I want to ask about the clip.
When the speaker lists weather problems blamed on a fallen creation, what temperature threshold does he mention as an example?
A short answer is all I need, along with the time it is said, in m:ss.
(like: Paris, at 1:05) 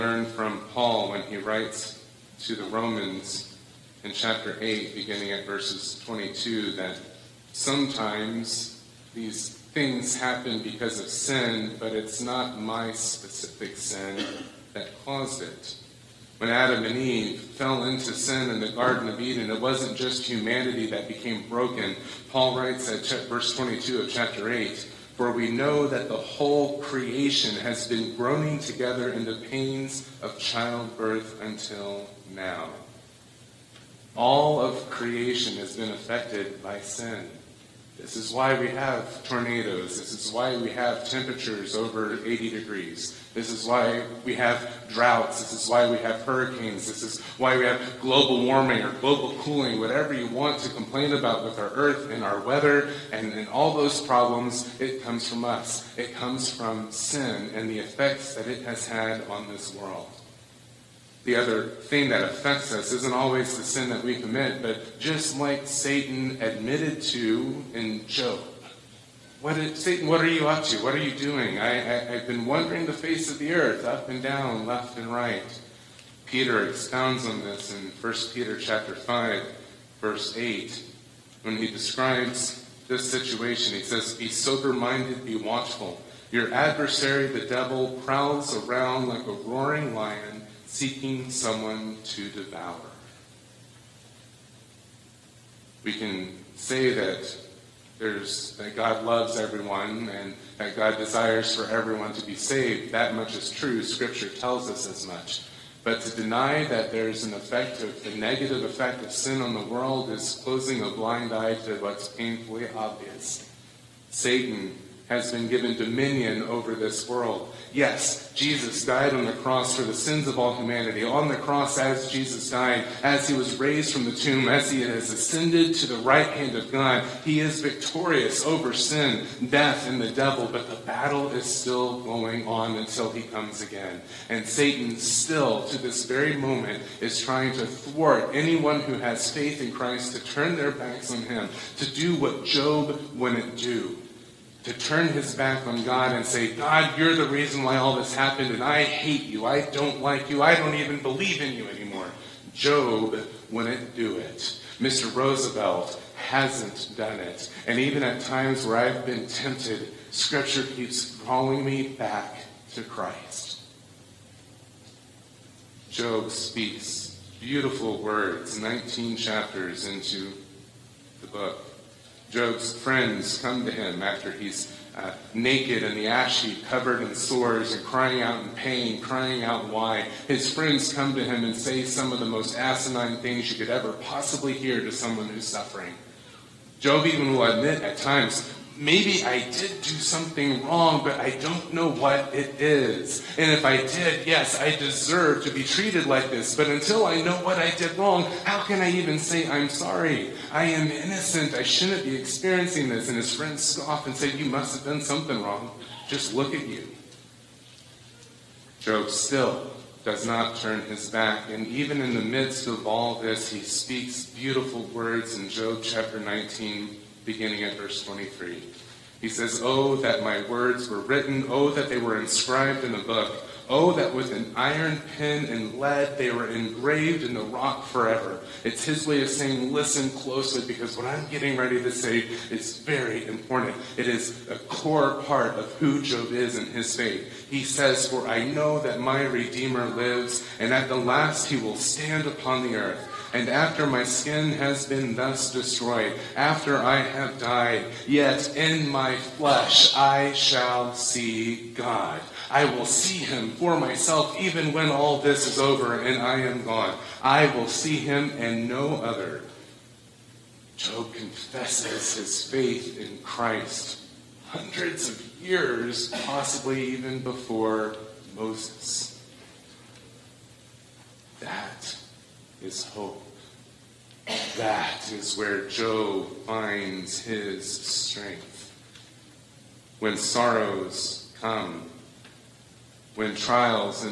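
80 degrees, at 0:42.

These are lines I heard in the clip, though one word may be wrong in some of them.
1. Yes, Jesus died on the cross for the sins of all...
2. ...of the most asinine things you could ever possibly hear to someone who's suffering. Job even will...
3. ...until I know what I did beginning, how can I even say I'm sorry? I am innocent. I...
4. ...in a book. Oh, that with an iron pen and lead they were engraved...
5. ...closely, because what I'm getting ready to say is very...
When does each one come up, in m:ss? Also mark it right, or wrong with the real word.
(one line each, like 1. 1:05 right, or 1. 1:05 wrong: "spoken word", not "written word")
1. 1:57 right
2. 3:02 right
3. 3:16 wrong: "wrong", not "beginning"
4. 3:42 right
5. 3:50 right.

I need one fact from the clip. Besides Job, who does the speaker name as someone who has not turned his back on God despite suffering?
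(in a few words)
Mr. Roosevelt.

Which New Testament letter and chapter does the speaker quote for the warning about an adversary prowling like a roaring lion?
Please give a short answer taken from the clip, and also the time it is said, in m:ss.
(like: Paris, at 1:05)
1 Peter chapter 5, at 1:18.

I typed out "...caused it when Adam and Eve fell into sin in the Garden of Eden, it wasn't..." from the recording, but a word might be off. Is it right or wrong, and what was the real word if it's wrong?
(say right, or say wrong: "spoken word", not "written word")
right.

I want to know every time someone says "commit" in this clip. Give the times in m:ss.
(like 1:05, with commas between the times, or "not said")
1:04.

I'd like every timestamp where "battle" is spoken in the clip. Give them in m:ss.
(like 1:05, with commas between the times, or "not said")
2:10.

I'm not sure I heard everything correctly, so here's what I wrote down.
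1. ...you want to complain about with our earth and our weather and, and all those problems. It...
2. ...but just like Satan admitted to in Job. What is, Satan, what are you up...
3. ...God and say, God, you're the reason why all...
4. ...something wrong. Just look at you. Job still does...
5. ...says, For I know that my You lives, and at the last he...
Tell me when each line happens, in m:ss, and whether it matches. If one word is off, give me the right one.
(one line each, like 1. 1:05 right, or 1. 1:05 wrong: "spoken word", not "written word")
1. 0:50 right
2. 1:04 right
3. 2:25 right
4. 3:25 right
5. 3:57 wrong: "Redeemer", not "You".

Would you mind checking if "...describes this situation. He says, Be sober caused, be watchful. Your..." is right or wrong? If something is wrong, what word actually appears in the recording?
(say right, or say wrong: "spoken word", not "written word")
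wrong: "minded", not "caused".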